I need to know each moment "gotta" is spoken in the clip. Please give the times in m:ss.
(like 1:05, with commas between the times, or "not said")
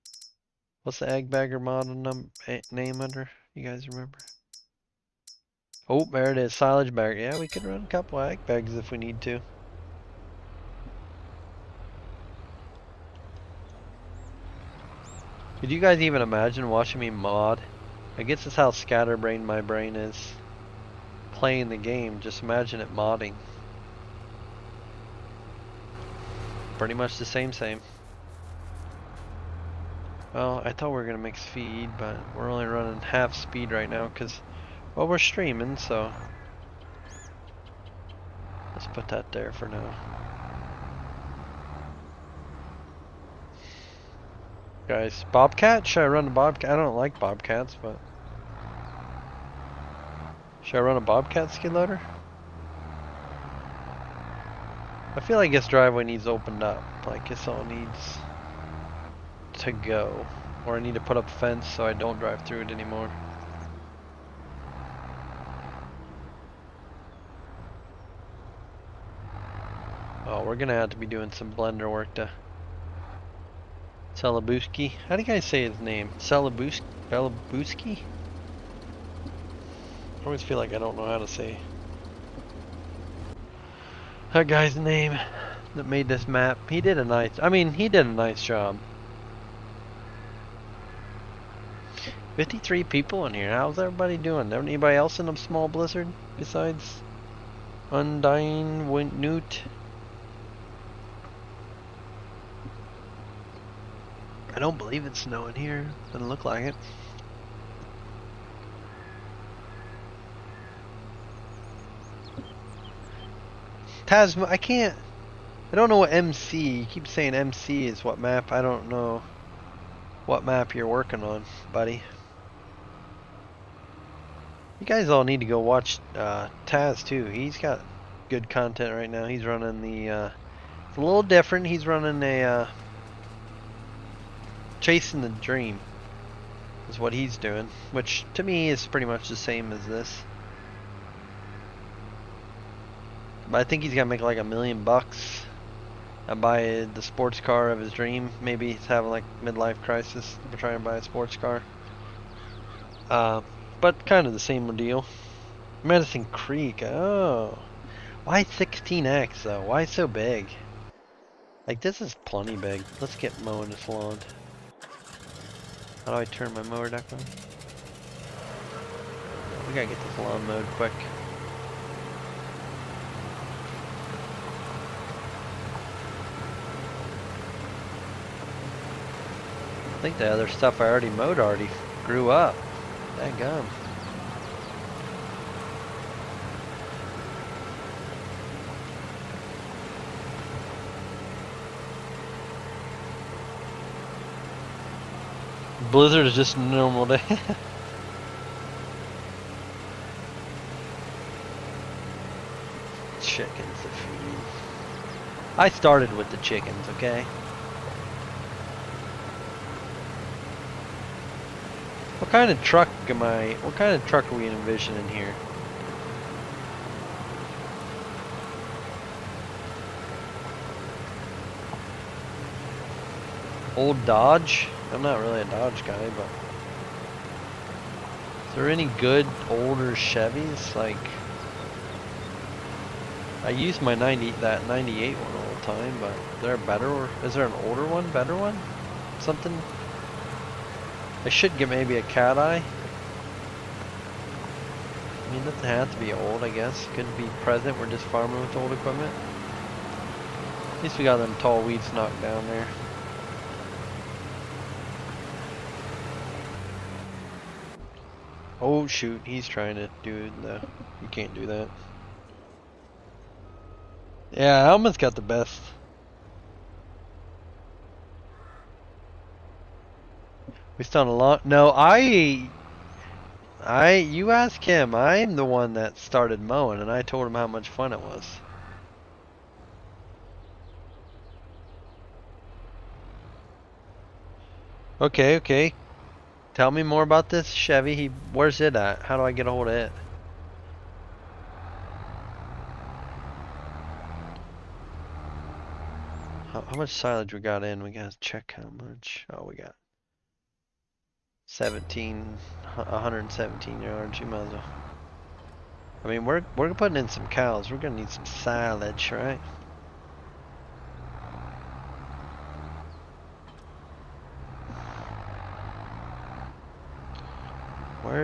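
2:49, 4:57.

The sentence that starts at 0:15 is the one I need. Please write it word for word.
Could you guys even imagine watching me mod I guess that's how scatterbrained my brain is.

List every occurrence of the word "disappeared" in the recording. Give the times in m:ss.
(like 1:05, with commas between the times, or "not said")
not said.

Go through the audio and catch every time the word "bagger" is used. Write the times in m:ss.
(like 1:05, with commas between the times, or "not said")
0:01.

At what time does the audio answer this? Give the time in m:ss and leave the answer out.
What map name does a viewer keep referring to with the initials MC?
2:35.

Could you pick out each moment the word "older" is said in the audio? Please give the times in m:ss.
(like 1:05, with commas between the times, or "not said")
3:49, 3:57.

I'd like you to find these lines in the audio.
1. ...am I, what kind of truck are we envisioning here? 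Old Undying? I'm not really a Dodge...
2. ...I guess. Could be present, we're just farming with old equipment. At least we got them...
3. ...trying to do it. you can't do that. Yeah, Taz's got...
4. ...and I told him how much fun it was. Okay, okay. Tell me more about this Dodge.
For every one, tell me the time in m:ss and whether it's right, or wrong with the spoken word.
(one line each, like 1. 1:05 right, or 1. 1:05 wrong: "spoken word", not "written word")
1. 3:33 wrong: "Dodge", not "Undying"
2. 4:06 right
3. 4:19 wrong: "Alman", not "Taz"
4. 4:36 wrong: "Chevy", not "Dodge".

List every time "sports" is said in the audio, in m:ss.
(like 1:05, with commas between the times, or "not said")
2:27, 2:31.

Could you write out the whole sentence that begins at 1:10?
Oh, we're gonna have to be doing some blender work to Salabuski.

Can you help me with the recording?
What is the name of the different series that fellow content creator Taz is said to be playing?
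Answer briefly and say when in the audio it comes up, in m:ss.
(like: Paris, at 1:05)
Chasing the dream, at 2:14.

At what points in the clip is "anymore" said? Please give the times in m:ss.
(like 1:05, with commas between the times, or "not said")
1:02.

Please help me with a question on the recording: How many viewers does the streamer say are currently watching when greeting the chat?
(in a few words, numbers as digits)
53.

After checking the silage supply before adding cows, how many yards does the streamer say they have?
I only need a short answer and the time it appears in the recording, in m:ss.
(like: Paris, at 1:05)
117 yards, at 5:02.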